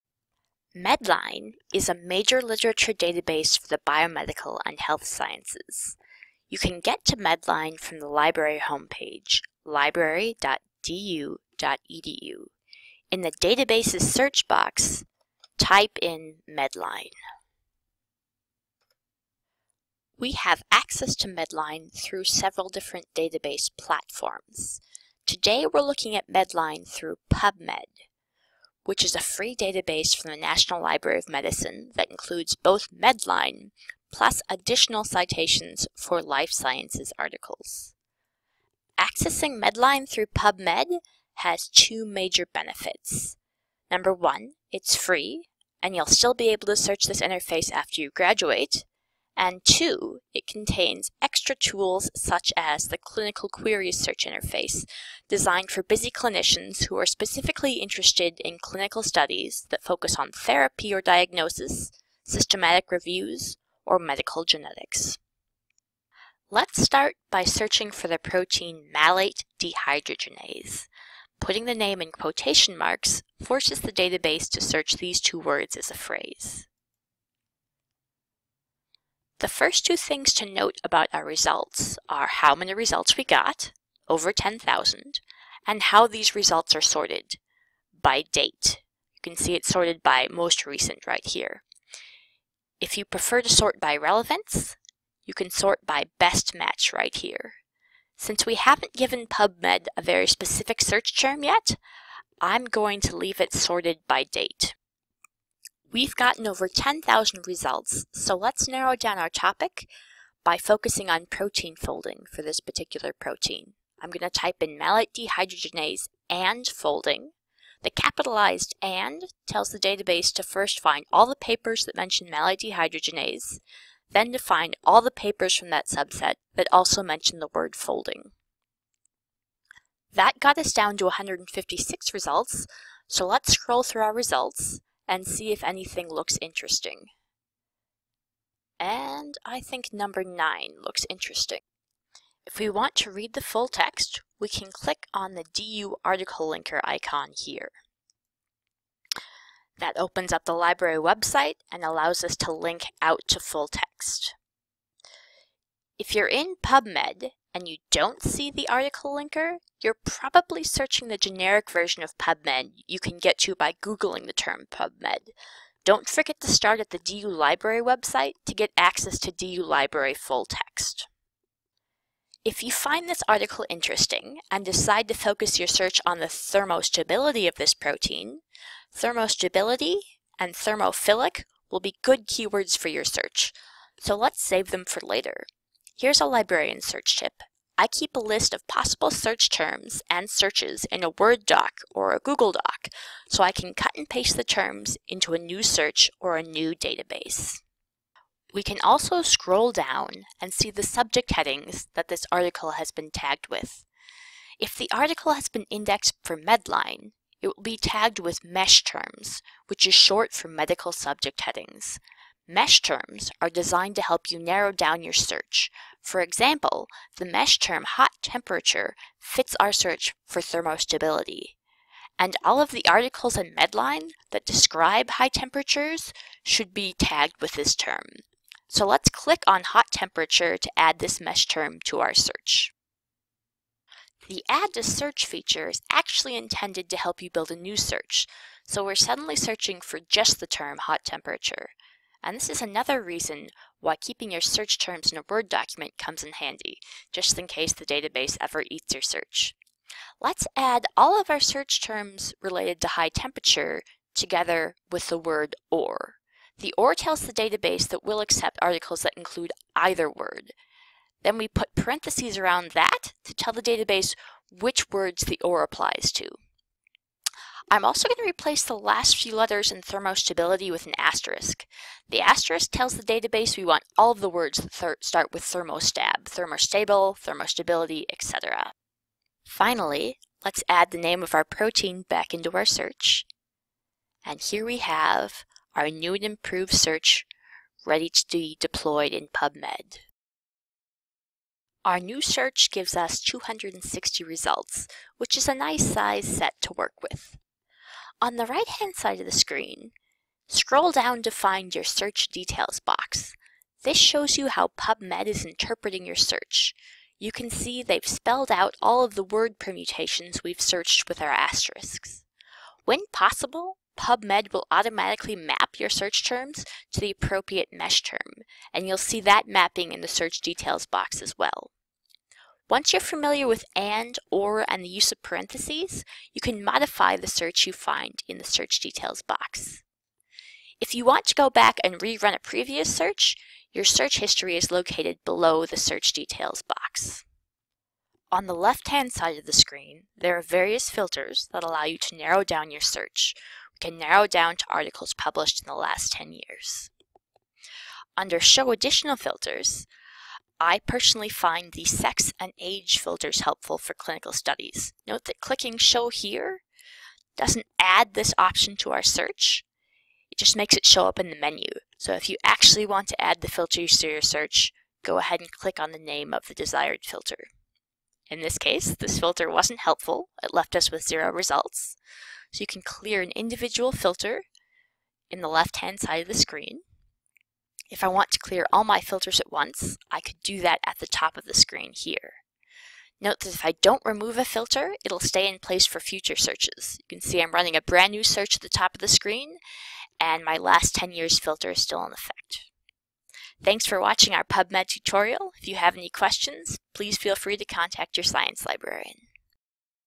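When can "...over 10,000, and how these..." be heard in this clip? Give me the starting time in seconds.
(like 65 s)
84 s.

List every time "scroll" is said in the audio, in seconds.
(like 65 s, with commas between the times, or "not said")
133 s, 199 s, 300 s.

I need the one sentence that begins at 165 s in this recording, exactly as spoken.
Don't forget to start at the DU Library website to get access to DU Library full text.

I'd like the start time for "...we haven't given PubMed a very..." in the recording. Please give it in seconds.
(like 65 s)
98 s.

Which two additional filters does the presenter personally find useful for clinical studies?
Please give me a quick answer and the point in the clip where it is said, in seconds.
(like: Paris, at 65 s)
sex and age, at 351 s.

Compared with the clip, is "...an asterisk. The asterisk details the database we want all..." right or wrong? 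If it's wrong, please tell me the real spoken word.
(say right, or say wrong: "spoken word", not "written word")
wrong: "tells", not "details".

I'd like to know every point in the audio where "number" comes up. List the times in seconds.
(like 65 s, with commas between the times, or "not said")
43 s, 139 s.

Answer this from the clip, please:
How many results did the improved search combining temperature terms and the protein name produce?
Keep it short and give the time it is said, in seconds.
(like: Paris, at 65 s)
260, at 293 s.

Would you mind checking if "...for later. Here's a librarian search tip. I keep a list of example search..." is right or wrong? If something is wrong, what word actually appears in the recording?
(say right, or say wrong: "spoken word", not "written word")
wrong: "possible", not "example".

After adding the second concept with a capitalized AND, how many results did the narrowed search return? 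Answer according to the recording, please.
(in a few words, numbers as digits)
156.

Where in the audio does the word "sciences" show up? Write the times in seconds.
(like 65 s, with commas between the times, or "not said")
5 s, 36 s, 398 s.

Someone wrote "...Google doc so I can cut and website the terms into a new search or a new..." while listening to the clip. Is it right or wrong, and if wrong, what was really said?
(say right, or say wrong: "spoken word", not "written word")
wrong: "paste", not "website".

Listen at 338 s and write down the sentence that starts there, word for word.
On the left-hand side of the screen, there are various filters that allow you to narrow down your search.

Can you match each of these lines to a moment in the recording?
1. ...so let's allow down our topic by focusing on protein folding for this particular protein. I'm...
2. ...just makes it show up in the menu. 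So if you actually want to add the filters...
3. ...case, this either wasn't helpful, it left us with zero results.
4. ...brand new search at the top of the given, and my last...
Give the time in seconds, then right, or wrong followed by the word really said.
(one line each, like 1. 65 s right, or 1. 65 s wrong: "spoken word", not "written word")
1. 108 s wrong: "narrow", not "allow"
2. 360 s right
3. 368 s wrong: "filter", not "either"
4. 387 s wrong: "screen", not "given".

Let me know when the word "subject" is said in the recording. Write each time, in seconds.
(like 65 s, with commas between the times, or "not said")
200 s, 210 s.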